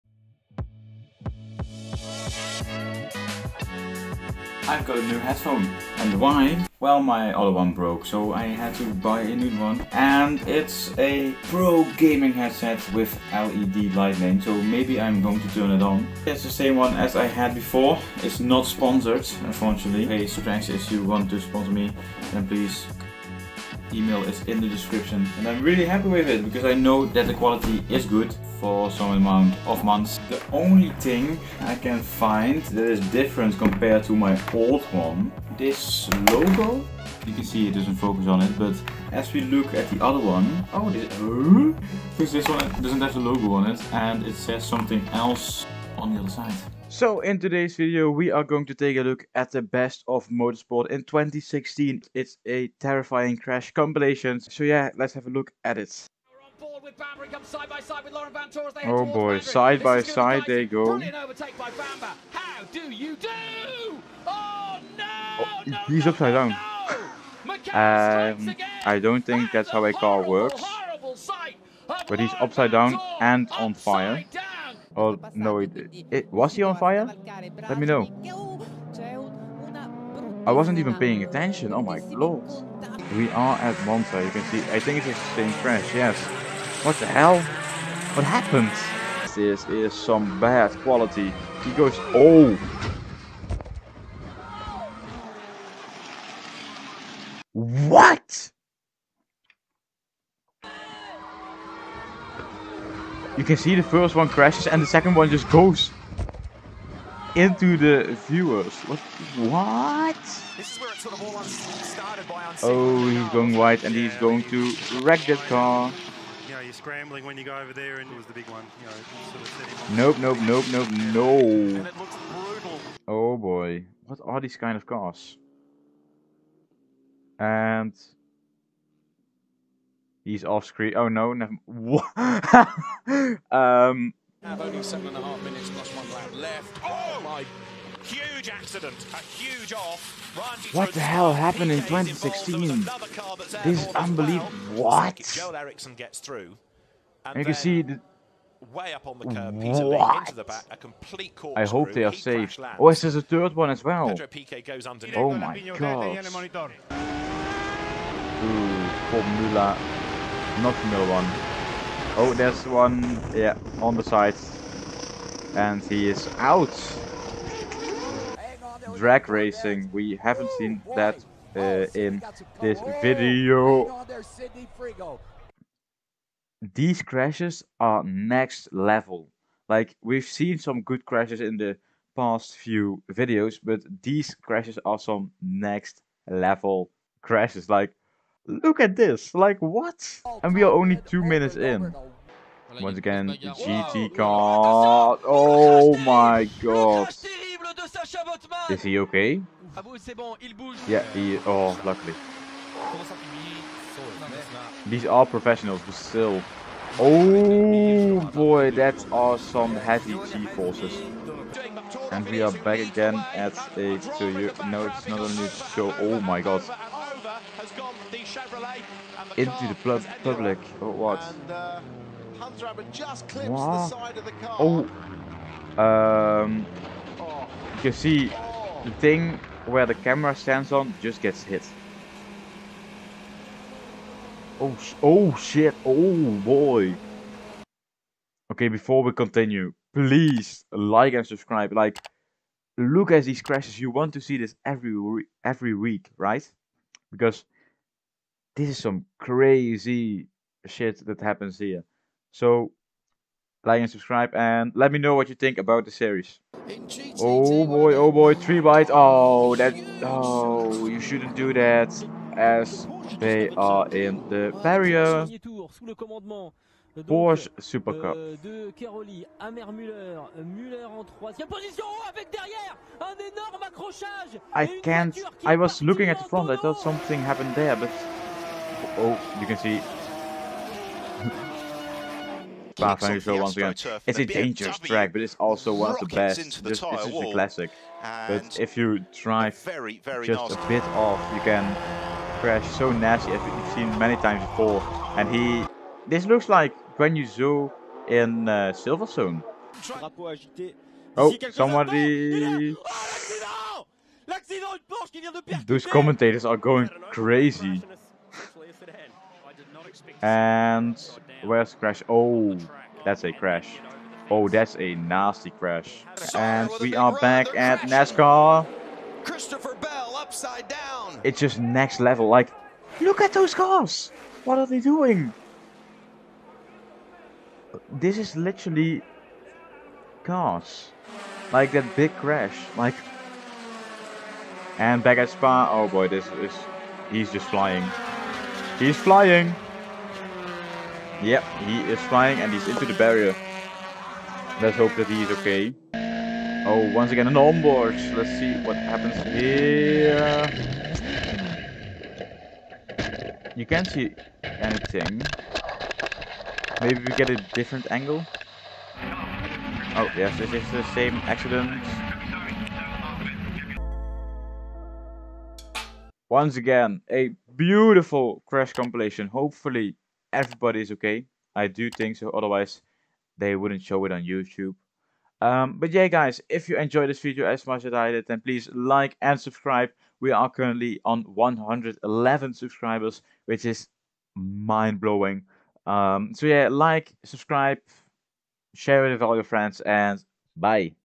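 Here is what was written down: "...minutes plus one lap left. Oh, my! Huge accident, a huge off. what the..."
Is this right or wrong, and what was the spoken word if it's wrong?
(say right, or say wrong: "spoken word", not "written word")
right.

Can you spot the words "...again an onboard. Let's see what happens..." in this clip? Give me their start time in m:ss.
5:47.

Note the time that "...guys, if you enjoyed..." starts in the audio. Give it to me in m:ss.
6:16.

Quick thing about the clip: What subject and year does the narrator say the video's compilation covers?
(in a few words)
motorsport in 2016.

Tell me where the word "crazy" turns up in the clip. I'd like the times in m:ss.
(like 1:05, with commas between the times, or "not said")
4:09, 5:07.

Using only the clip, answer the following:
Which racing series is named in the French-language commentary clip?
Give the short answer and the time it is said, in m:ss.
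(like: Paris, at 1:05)
Porsche Supercup, at 4:27.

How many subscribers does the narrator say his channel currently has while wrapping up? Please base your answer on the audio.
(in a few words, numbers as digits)
111.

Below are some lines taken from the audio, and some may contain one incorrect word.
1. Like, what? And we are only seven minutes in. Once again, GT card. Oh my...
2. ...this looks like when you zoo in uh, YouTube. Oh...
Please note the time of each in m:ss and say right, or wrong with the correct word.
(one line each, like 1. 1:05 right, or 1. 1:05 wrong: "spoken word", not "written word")
1. 3:09 wrong: "two", not "seven"
2. 4:56 wrong: "Silverstone", not "YouTube".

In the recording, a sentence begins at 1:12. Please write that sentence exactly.
But he's upside down and on fire.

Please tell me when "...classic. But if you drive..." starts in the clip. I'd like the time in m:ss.
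4:47.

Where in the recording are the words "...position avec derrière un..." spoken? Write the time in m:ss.
4:31.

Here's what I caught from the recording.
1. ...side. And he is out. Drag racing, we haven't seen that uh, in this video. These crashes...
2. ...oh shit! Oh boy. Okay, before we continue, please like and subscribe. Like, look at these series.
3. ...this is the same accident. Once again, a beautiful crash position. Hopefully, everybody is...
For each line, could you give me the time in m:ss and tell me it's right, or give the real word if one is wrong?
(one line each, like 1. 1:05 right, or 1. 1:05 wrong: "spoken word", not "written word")
1. 2:44 right
2. 3:55 wrong: "crashes", not "series"
3. 6:00 wrong: "compilation", not "position".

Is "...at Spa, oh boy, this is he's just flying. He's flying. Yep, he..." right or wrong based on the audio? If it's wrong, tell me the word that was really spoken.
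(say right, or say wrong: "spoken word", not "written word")
right.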